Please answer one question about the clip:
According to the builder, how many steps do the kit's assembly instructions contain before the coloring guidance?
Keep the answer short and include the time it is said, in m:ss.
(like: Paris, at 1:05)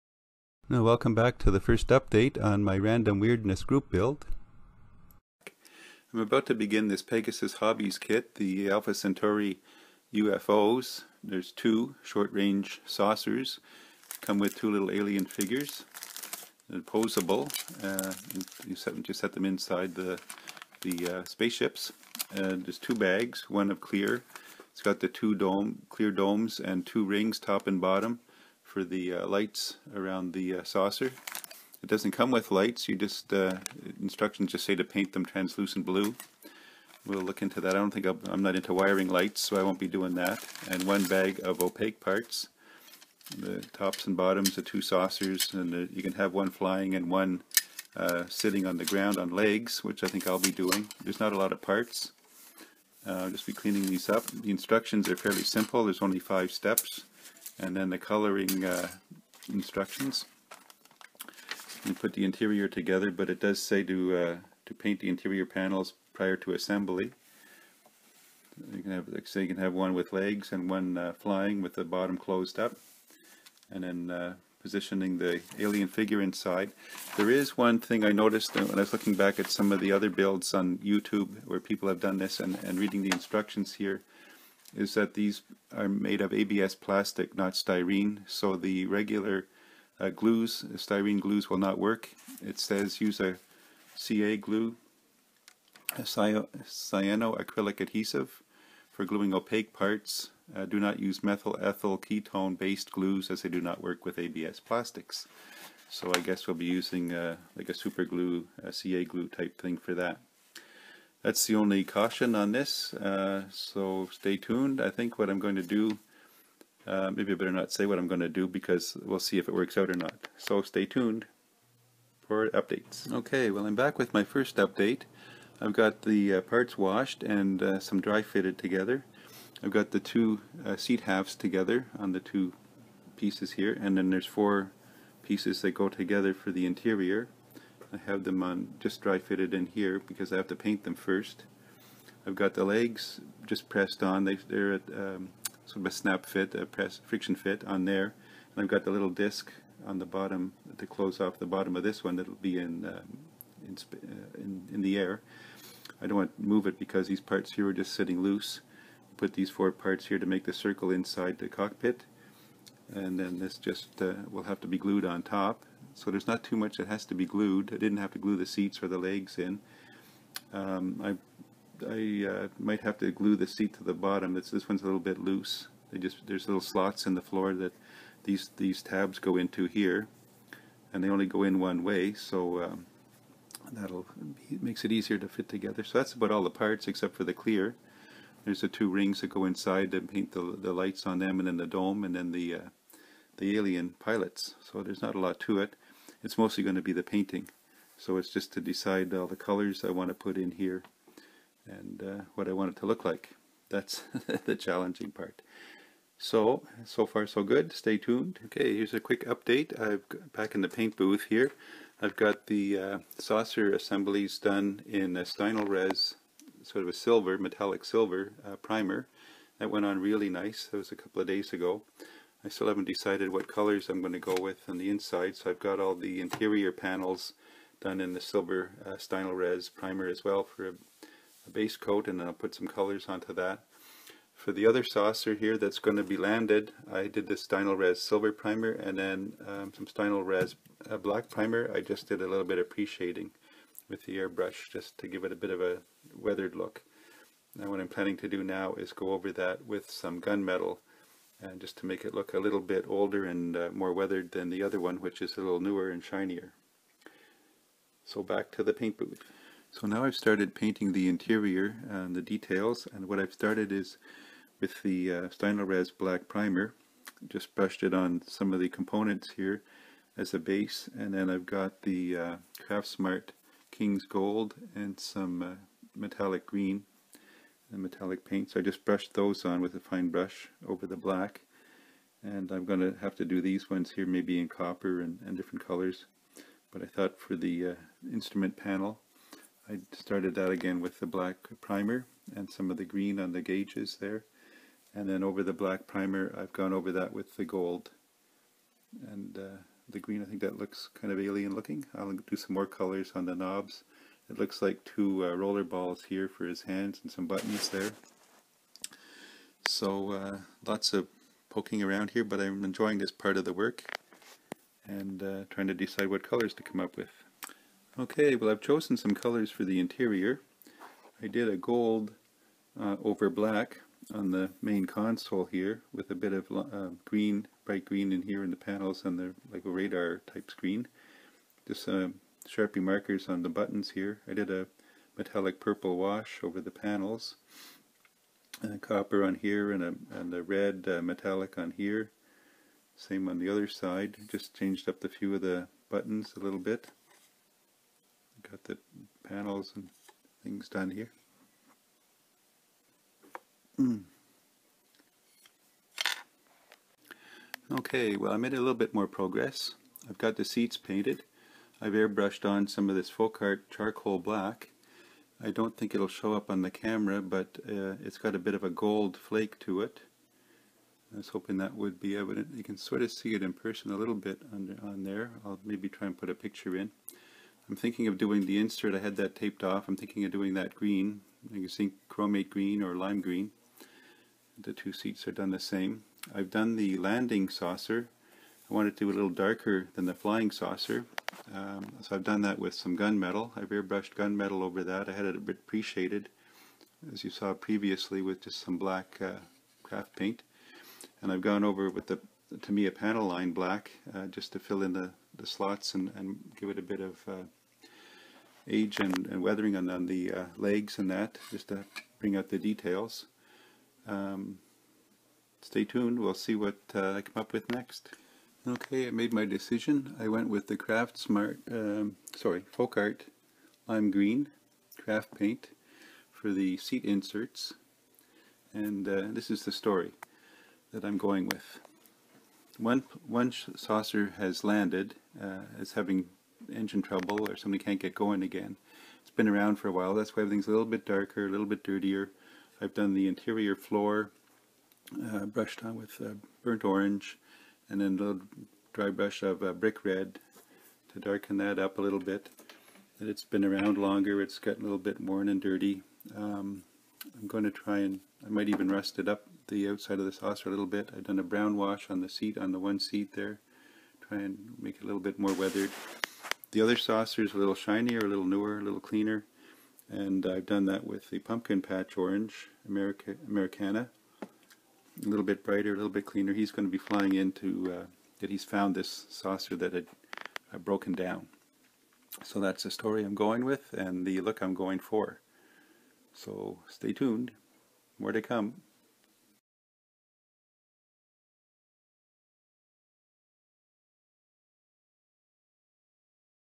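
5, at 0:56.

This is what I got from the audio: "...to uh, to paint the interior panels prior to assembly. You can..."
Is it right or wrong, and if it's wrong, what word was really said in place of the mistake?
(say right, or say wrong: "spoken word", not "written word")
right.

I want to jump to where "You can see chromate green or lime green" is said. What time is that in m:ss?
6:21.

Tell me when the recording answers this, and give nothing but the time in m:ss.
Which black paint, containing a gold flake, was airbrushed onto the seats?
6:03.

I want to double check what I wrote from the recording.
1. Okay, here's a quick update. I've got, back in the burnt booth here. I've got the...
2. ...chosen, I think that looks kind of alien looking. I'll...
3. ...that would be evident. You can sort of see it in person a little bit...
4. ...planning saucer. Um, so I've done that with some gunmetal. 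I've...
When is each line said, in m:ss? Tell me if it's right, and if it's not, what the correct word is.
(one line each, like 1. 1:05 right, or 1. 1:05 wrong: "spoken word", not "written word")
1. 3:28 wrong: "paint", not "burnt"
2. 4:59 wrong: "green", not "chosen"
3. 6:11 right
4. 6:30 wrong: "flying", not "planning".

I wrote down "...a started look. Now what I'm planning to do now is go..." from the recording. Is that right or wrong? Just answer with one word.
wrong.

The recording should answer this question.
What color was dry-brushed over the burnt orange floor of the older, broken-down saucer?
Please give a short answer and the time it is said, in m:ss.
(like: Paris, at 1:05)
Brick red, at 7:29.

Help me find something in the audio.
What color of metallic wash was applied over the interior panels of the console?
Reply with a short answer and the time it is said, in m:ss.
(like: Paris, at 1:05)
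Purple, at 5:35.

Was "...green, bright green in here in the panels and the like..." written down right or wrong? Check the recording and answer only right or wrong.
right.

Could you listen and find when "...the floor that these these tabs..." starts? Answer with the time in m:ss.
2:57.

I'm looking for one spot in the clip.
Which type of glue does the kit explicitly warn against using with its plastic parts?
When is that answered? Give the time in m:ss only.
1:41.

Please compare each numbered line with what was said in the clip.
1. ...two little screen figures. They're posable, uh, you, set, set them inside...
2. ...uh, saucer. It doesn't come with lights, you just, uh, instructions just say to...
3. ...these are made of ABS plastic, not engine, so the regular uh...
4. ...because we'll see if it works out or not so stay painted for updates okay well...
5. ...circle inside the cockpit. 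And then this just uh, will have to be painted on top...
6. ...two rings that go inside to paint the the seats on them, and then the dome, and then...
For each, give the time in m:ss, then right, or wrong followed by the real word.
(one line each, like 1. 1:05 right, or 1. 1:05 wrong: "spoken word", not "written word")
1. 0:14 wrong: "alien", not "screen"
2. 0:30 right
3. 1:25 wrong: "styrene", not "engine"
4. 1:58 wrong: "tuned", not "painted"
5. 2:40 wrong: "glued", not "painted"
6. 3:08 wrong: "lights", not "seats".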